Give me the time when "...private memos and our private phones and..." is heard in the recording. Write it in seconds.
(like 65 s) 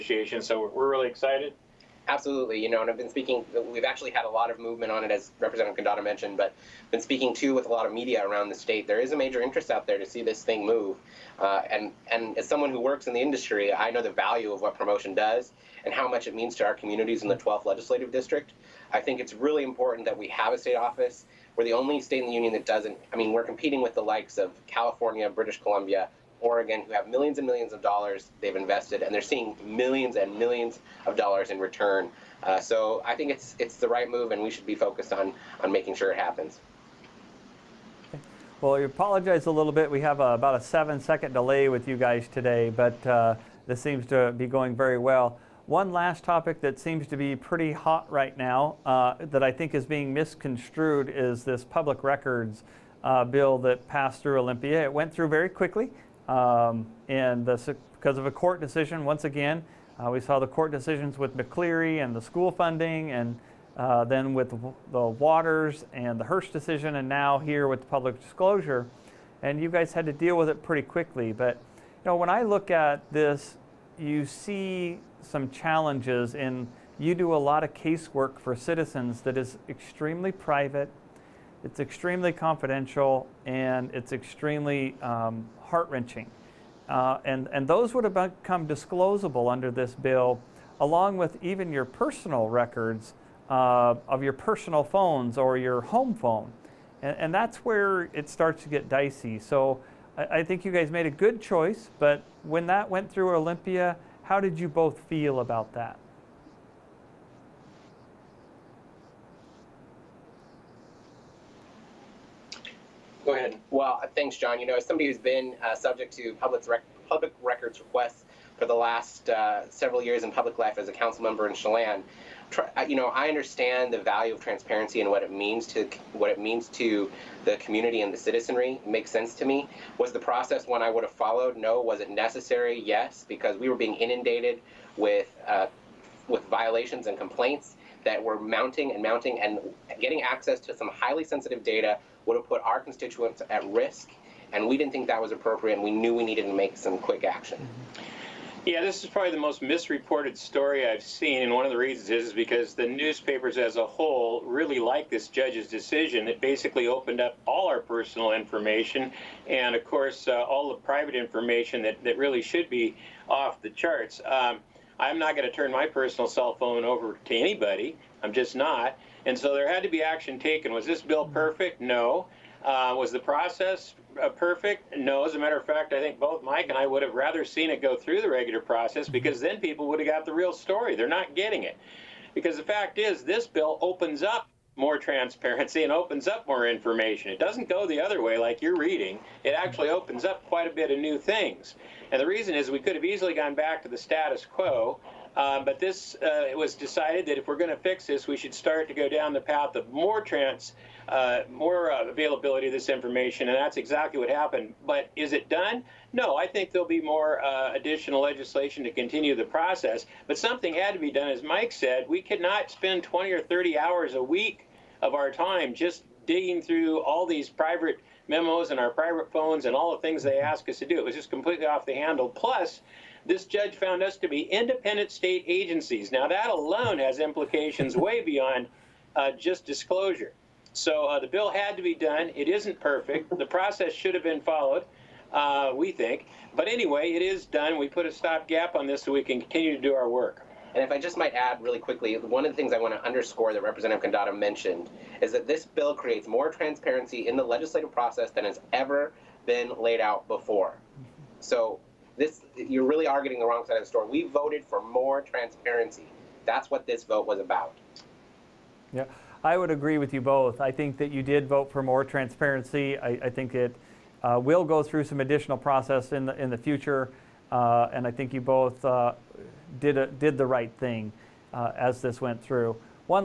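217 s.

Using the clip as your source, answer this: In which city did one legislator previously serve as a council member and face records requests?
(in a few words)
Chelan.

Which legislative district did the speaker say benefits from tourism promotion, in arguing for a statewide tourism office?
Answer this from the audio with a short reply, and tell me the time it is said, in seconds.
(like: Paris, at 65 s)
12th, at 17 s.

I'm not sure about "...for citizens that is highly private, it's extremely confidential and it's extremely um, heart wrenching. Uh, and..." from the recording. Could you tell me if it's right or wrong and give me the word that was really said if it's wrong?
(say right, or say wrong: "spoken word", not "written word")
wrong: "extremely", not "highly".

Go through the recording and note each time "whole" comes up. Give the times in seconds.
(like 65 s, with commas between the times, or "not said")
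153 s.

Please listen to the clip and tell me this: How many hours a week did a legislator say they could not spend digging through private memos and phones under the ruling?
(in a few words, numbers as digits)
20 or 30.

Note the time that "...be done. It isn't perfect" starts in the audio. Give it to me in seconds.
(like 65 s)
231 s.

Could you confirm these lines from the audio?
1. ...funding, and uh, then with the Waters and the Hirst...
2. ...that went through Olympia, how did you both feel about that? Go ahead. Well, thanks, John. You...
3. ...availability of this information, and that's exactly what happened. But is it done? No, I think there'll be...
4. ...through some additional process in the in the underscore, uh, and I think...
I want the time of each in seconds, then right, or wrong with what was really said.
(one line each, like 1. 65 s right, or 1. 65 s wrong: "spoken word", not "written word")
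1. 62 s right
2. 102 s right
3. 202 s right
4. 264 s wrong: "future", not "underscore".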